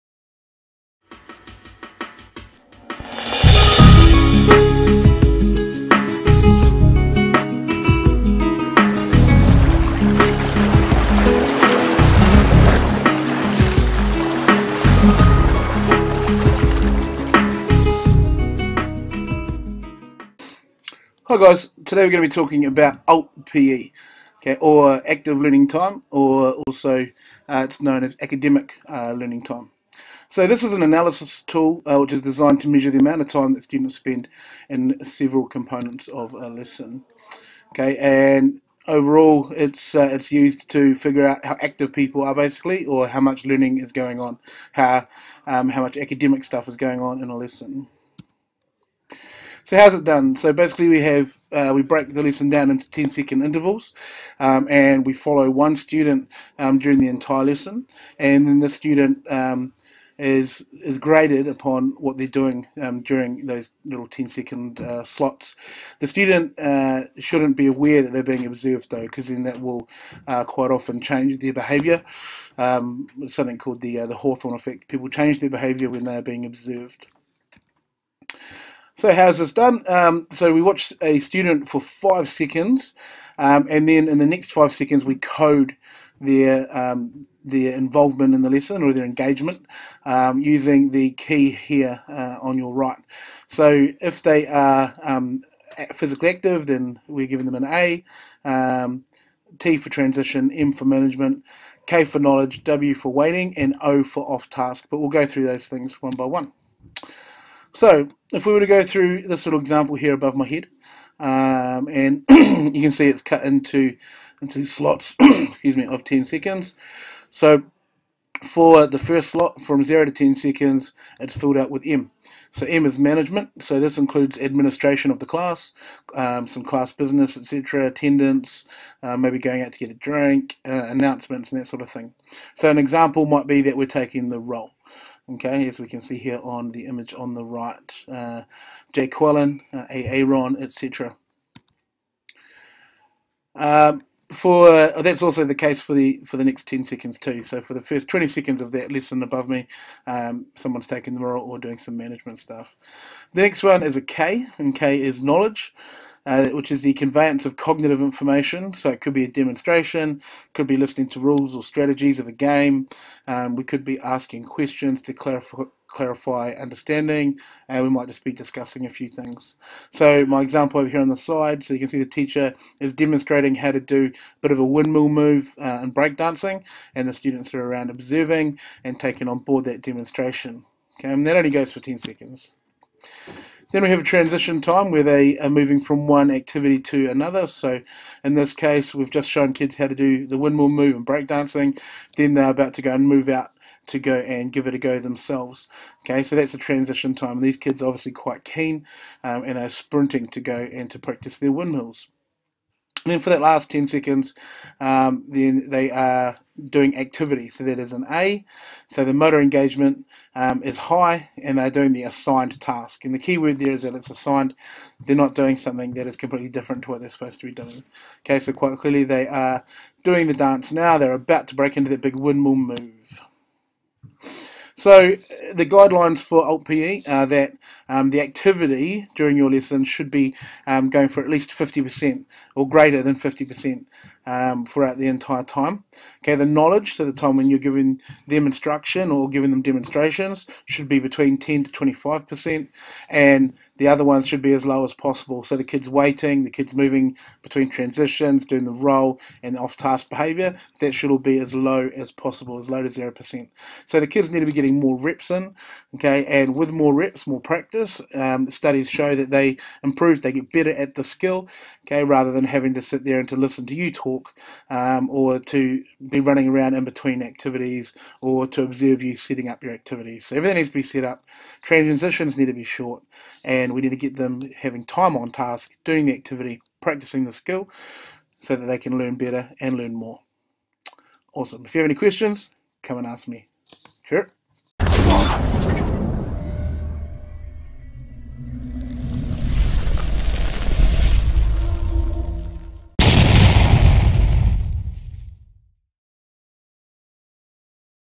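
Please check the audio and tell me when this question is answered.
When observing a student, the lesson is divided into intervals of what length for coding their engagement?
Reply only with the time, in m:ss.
0:52.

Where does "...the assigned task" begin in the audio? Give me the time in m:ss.
3:31.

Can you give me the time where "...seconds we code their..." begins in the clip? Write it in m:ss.
1:24.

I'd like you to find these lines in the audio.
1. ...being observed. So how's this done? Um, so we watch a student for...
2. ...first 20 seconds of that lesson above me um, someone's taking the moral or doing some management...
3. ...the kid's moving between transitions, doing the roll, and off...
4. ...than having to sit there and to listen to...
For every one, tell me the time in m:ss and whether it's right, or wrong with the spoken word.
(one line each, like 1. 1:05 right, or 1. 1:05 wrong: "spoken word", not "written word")
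1. 1:16 right
2. 2:27 right
3. 4:06 right
4. 4:22 right.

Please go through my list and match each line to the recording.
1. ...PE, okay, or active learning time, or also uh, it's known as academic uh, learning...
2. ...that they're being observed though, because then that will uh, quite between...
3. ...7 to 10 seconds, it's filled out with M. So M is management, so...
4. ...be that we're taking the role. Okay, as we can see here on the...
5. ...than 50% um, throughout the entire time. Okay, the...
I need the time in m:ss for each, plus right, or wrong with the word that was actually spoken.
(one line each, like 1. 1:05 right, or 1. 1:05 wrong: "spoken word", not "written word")
1. 0:23 right
2. 1:08 wrong: "often", not "between"
3. 1:59 wrong: "0", not "7"
4. 2:13 right
5. 3:53 right.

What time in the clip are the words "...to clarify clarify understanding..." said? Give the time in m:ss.
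2:45.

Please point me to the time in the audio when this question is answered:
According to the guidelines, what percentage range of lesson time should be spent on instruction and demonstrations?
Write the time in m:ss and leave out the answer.
4:01.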